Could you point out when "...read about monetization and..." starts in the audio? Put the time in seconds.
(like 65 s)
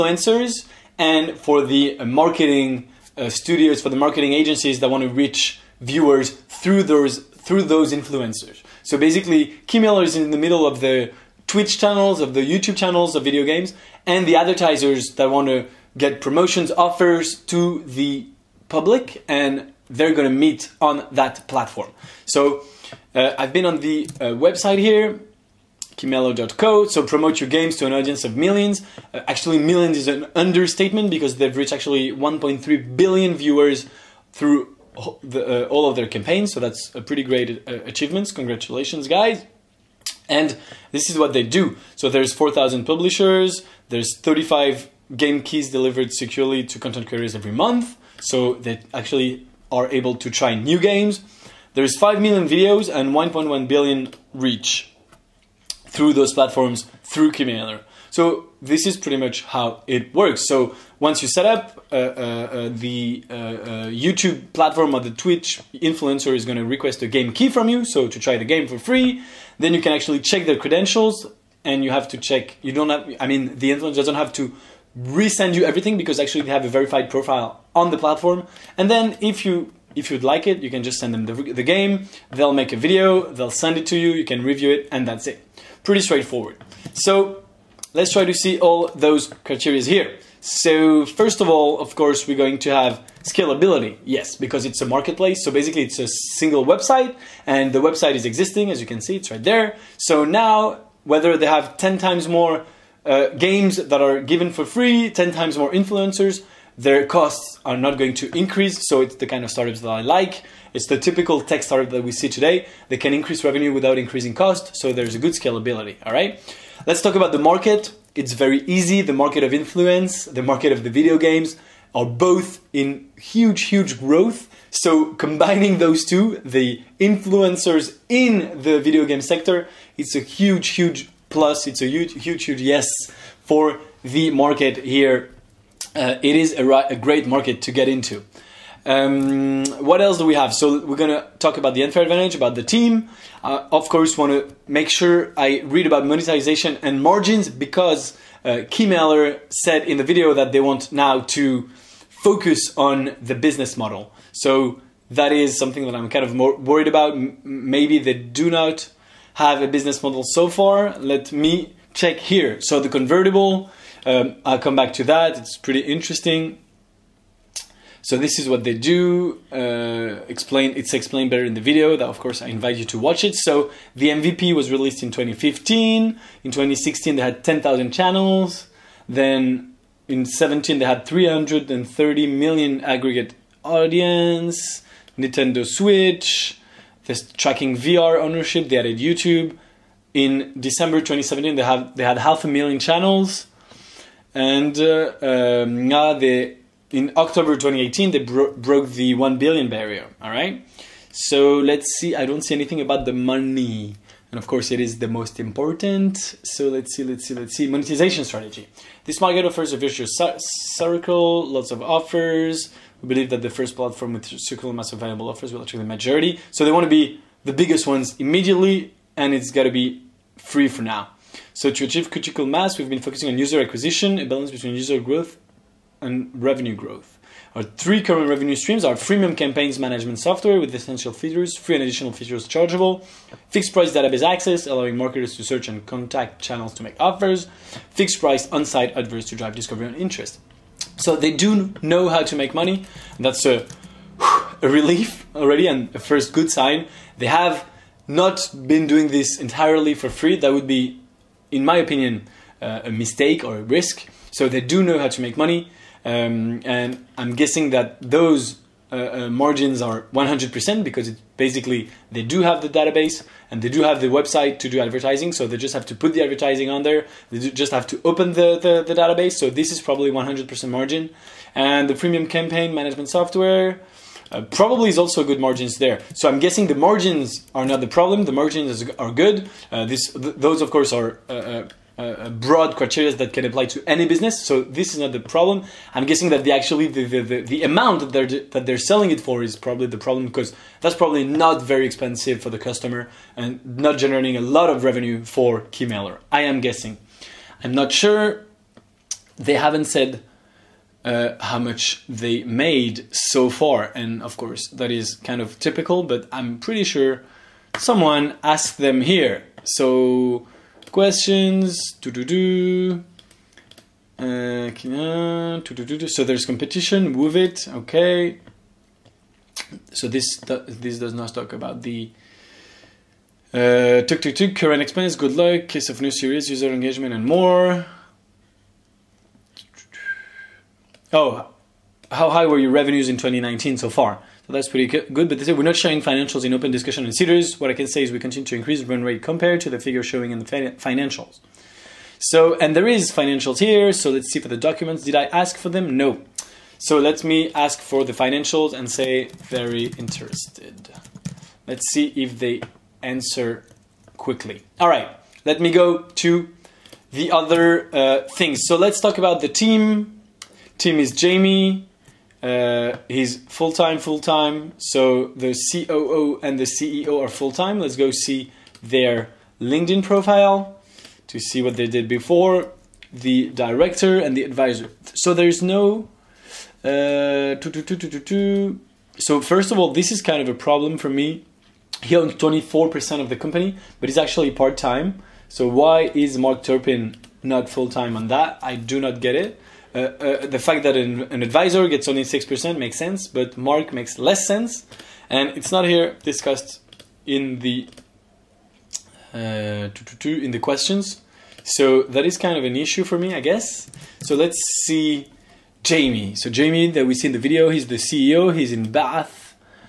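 145 s.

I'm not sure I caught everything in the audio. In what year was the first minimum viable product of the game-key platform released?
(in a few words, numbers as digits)
2015.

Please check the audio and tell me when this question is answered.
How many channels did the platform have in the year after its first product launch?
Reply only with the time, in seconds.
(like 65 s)
177 s.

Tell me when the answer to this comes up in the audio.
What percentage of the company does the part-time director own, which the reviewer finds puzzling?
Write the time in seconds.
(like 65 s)
382 s.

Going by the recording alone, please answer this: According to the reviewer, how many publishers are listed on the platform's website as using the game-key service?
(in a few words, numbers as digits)
4,000.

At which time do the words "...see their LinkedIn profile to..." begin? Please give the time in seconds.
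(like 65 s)
368 s.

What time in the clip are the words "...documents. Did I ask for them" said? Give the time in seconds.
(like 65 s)
344 s.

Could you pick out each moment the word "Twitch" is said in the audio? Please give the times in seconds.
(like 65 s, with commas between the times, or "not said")
11 s, 65 s.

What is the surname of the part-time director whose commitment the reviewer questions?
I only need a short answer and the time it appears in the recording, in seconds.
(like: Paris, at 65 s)
Turpin, at 386 s.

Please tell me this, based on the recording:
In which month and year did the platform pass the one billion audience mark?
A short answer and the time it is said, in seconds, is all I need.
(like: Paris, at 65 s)
October 2018, at 197 s.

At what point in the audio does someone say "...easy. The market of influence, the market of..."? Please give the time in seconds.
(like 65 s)
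118 s.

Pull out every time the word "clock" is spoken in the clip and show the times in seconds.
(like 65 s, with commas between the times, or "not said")
not said.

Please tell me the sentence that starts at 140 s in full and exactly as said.
So we're gonna talk about the unfair advantage, about the team.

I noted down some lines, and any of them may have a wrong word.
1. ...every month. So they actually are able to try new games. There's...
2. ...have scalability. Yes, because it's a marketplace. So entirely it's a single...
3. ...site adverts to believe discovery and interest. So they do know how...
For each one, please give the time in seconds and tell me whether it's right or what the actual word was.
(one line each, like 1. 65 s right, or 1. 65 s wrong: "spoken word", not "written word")
1. 47 s right
2. 92 s wrong: "basically", not "entirely"
3. 238 s wrong: "drive", not "believe".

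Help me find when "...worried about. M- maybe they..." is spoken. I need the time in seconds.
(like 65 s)
156 s.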